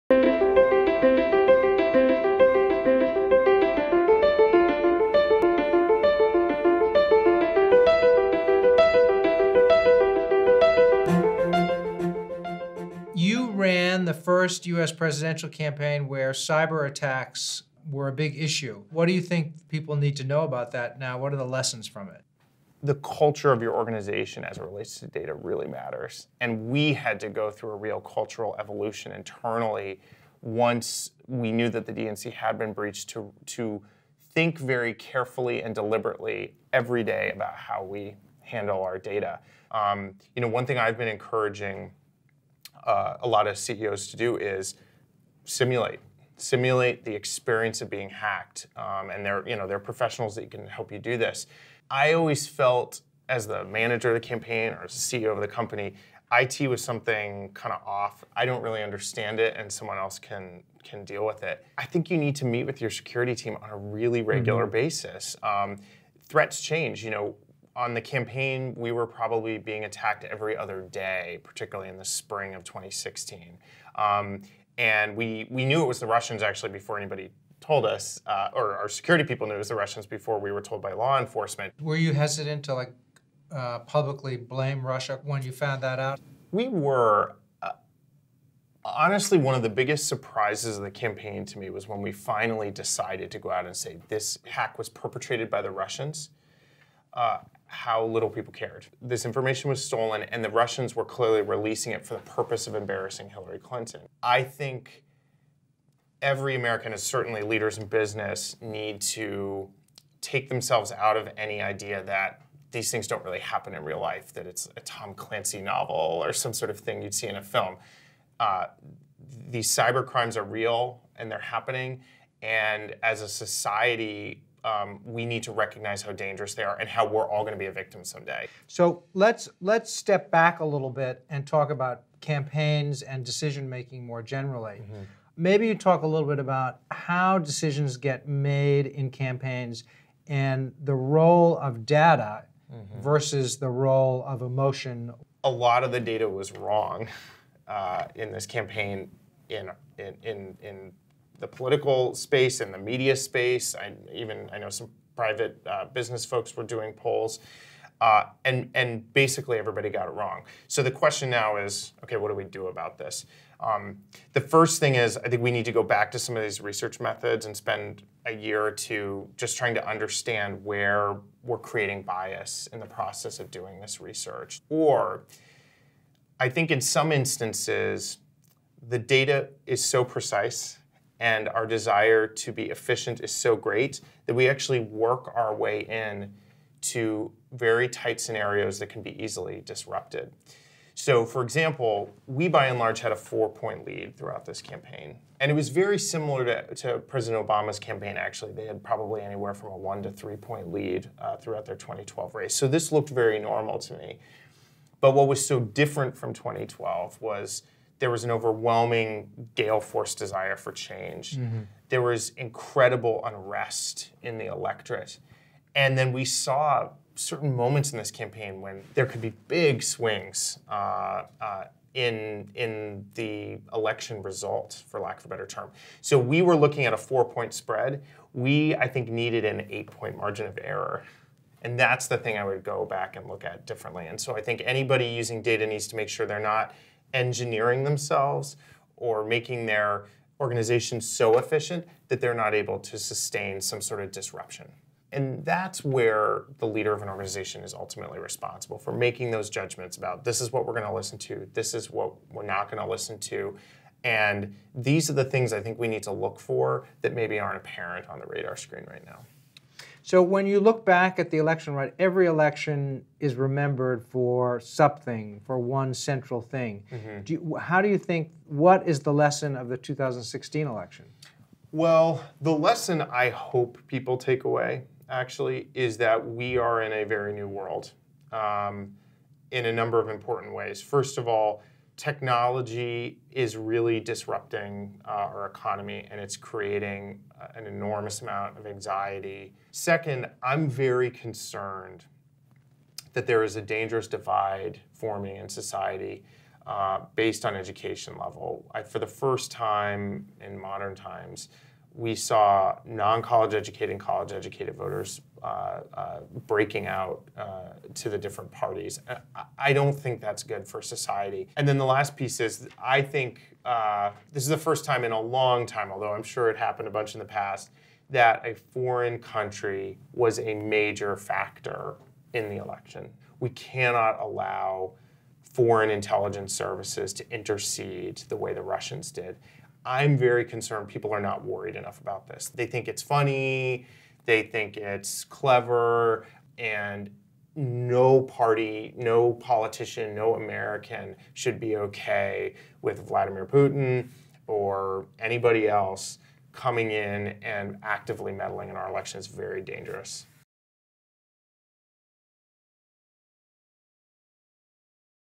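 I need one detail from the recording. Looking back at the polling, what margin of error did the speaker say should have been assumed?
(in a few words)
8 points.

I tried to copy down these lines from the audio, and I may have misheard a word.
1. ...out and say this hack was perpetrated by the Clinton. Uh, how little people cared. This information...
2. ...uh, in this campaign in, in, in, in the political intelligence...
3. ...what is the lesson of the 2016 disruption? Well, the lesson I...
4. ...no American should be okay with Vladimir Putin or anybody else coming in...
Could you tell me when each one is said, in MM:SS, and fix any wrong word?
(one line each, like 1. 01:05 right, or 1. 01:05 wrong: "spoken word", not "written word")
1. 01:33 wrong: "Russians", not "Clinton"
2. 02:27 wrong: "space", not "intelligence"
3. 04:28 wrong: "election", not "disruption"
4. 05:40 right.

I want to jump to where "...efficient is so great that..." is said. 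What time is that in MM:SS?
03:02.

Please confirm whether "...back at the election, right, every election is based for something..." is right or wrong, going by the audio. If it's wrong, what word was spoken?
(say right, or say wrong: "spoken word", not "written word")
wrong: "remembered", not "based".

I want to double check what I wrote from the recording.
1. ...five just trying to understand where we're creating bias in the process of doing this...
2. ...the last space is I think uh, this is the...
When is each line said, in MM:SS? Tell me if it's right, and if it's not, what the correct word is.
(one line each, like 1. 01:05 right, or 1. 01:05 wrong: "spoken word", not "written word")
1. 02:48 wrong: "two", not "five"
2. 05:11 wrong: "piece", not "space".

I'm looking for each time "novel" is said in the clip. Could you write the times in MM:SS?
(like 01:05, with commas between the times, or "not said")
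01:55.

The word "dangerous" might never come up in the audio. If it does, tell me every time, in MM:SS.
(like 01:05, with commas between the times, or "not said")
02:06, 04:53, 05:49.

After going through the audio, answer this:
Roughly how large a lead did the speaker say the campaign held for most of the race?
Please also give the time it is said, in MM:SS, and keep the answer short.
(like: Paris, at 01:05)
4 points, at 03:13.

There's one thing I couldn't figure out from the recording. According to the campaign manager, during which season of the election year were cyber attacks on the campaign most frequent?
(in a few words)
spring of 2016.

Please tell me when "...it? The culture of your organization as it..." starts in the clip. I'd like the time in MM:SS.
00:22.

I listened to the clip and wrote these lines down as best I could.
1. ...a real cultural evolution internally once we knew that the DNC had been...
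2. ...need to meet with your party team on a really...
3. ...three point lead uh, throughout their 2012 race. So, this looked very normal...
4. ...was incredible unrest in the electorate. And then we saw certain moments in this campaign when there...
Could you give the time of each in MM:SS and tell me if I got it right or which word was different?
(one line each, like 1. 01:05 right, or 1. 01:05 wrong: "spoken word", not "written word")
1. 00:27 right
2. 01:02 wrong: "security", not "party"
3. 03:20 right
4. 03:32 right.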